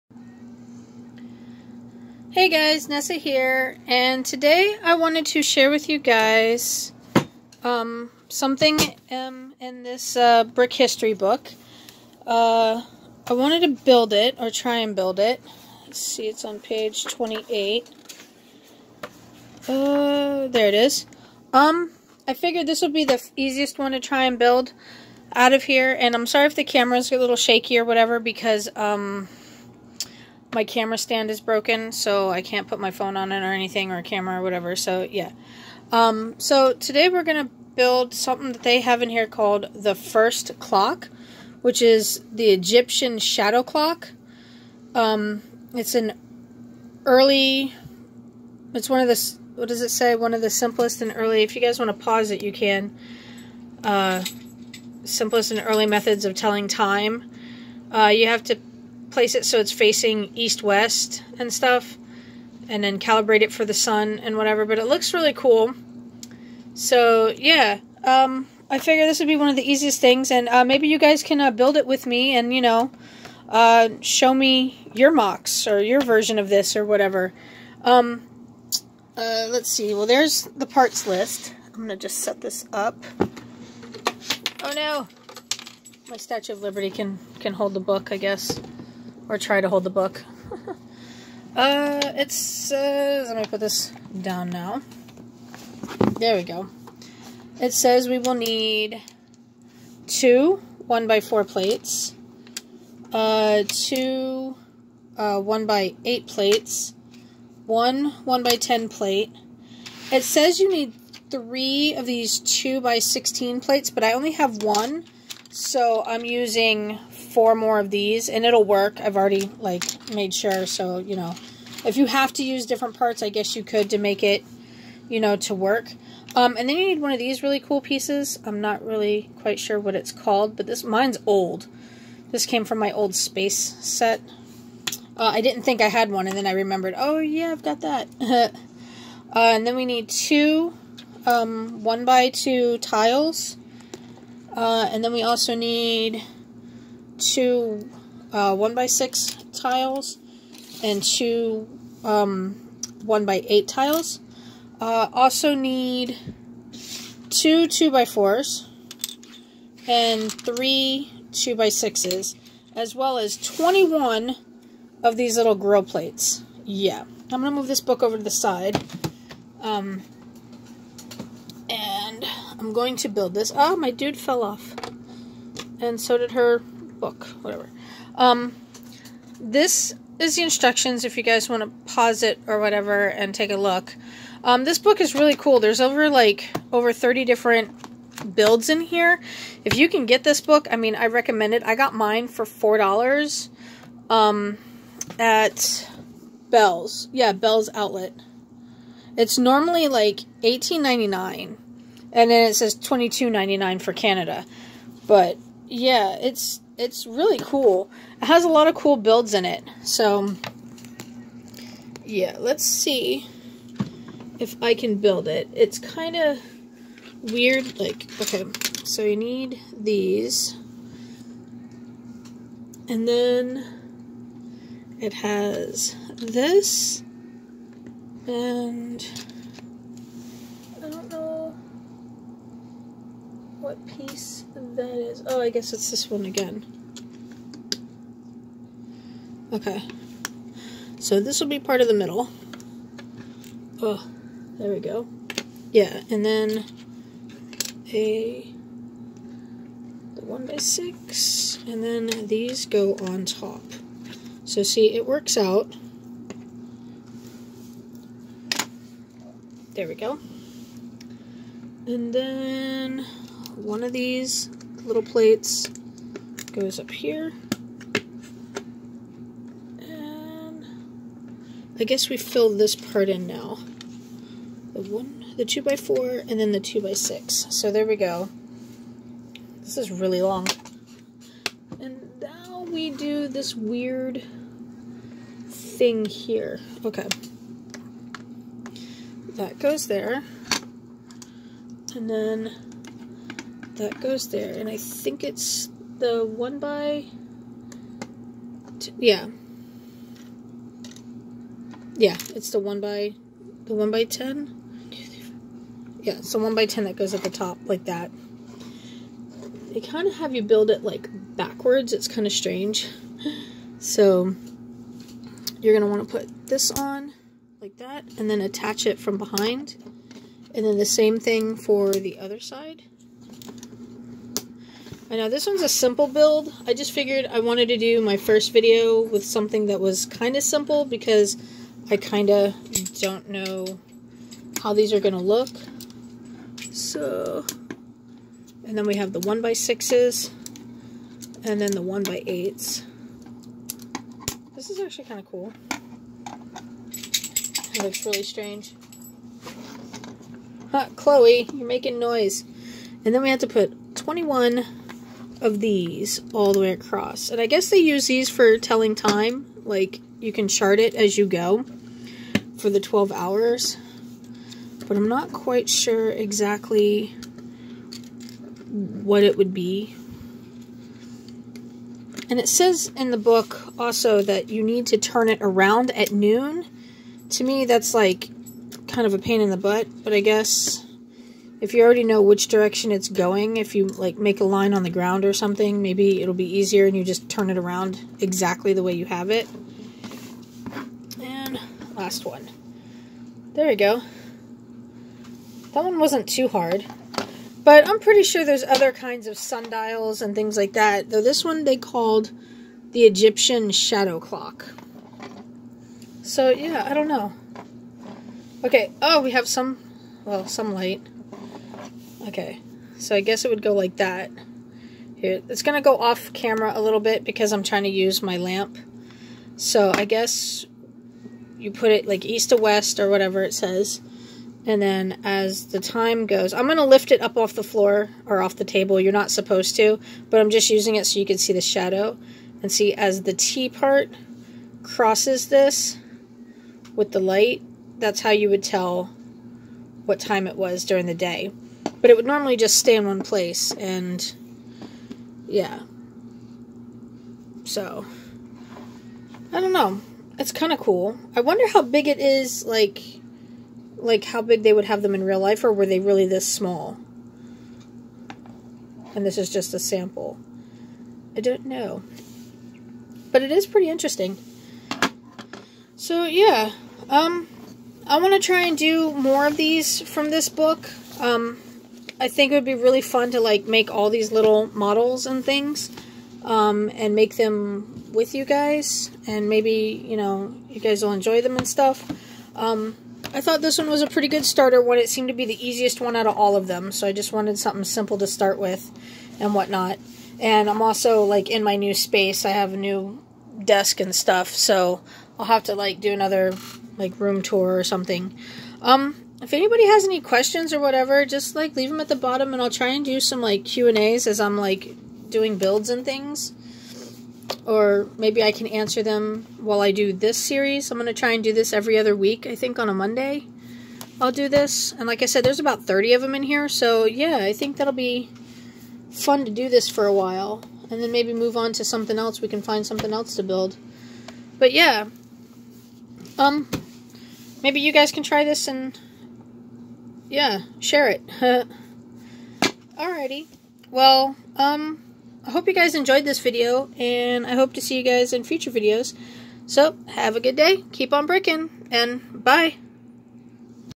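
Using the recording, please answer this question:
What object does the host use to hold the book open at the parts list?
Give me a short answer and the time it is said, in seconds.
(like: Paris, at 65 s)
Statue of Liberty, at 86 s.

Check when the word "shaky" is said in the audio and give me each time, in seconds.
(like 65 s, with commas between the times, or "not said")
27 s.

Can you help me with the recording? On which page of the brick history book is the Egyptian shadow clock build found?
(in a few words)
28.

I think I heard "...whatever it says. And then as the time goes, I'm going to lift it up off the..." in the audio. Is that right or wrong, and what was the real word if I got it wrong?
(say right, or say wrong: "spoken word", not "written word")
right.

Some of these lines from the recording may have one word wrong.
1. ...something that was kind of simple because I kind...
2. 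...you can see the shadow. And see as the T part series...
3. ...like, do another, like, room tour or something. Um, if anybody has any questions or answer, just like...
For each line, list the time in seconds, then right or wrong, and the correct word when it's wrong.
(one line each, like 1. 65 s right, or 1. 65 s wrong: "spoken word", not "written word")
1. 329 s right
2. 431 s wrong: "crosses", not "series"
3. 495 s wrong: "whatever", not "answer".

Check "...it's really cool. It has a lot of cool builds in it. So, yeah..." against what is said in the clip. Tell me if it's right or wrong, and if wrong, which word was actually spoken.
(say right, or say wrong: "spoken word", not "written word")
right.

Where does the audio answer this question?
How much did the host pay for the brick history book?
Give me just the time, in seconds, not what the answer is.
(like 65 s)
192 s.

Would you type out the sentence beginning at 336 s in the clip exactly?
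So, and then we have the 1 by 6s and then the 1 by 8s This is actually kind of cool.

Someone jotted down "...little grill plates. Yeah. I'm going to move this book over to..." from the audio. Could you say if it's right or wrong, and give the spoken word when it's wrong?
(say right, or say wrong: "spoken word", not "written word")
right.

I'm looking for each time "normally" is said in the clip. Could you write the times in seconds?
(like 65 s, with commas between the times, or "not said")
199 s, 442 s.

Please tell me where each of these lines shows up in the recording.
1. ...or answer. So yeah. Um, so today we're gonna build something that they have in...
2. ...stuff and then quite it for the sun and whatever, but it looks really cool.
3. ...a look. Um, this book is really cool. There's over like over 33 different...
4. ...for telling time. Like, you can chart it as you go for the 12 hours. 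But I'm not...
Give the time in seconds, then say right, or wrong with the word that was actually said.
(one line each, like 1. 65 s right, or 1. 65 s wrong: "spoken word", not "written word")
1. 34 s wrong: "whatever", not "answer"
2. 61 s wrong: "calibrate", not "quite"
3. 183 s wrong: "30", not "33"
4. 358 s right.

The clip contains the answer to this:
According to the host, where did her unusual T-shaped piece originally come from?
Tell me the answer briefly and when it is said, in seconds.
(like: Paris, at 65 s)
old space set, at 132 s.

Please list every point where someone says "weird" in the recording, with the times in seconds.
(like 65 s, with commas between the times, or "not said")
217 s, 283 s.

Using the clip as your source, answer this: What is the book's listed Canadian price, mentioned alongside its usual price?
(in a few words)
22.99.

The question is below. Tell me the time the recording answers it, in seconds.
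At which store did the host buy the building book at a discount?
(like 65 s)
197 s.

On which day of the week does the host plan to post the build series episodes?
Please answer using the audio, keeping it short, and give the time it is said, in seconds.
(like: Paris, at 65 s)
Monday, at 512 s.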